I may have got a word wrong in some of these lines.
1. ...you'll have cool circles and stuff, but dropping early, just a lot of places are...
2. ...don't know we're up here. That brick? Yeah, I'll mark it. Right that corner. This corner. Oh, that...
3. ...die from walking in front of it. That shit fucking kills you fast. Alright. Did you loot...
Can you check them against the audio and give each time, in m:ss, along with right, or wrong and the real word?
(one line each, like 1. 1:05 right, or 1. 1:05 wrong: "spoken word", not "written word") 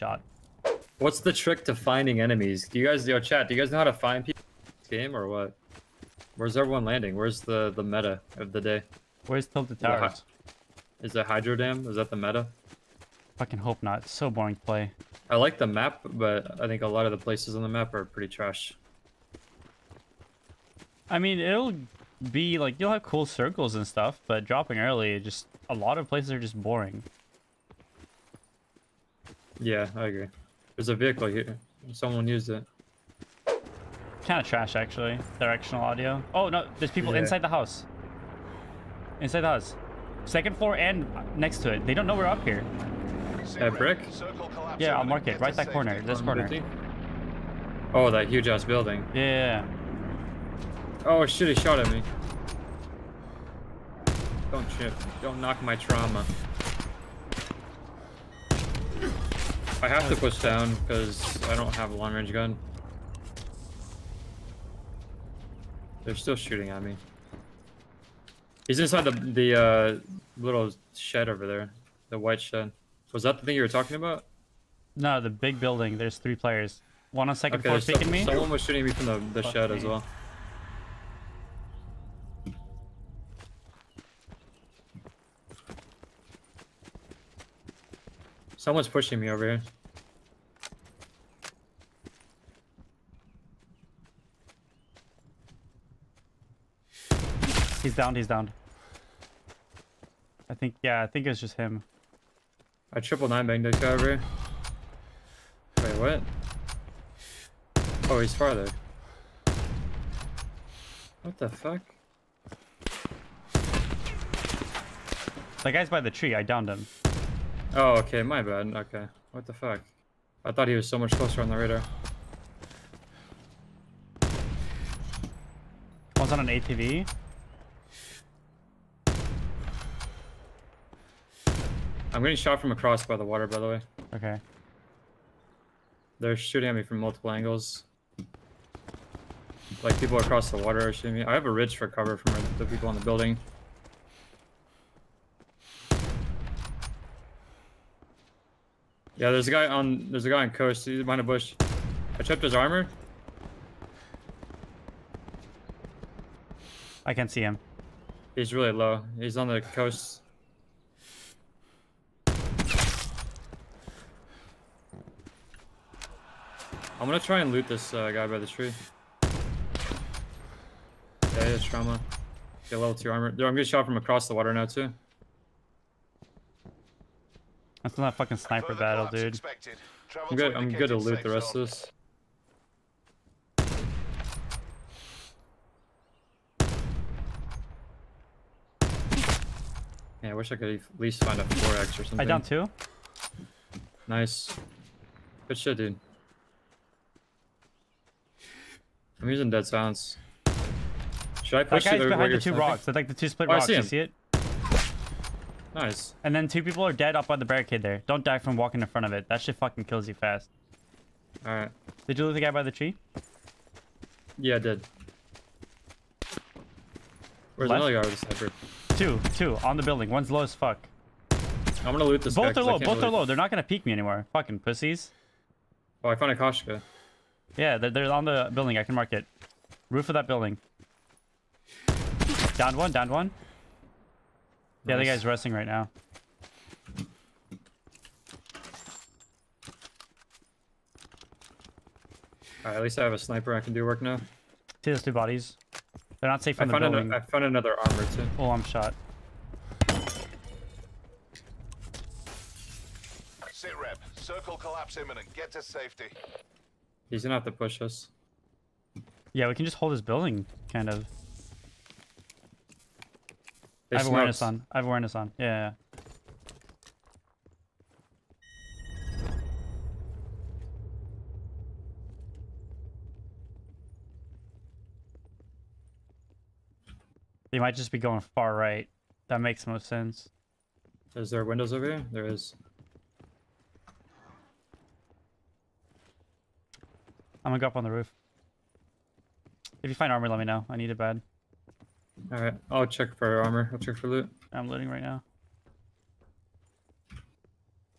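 1. 0:22 right
2. 0:41 right
3. 3:28 right.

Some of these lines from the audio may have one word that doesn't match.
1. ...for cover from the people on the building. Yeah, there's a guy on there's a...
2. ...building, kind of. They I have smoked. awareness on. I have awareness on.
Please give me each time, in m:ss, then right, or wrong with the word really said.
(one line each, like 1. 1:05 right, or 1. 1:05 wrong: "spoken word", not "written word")
1. 2:21 right
2. 4:20 right.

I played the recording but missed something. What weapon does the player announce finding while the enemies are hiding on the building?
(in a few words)
Koshka.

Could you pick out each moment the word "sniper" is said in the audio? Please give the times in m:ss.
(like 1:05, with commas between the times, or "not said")
2:58, 3:38, 4:03.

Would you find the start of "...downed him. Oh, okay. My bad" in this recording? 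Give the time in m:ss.
1:56.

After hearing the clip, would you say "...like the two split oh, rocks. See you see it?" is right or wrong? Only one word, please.
right.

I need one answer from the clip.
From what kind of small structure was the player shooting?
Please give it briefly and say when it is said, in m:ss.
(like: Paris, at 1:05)
white shed, at 1:12.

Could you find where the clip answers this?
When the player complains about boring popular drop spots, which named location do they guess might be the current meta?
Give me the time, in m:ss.
0:11.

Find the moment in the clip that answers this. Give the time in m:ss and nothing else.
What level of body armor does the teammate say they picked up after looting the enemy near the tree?
2:52.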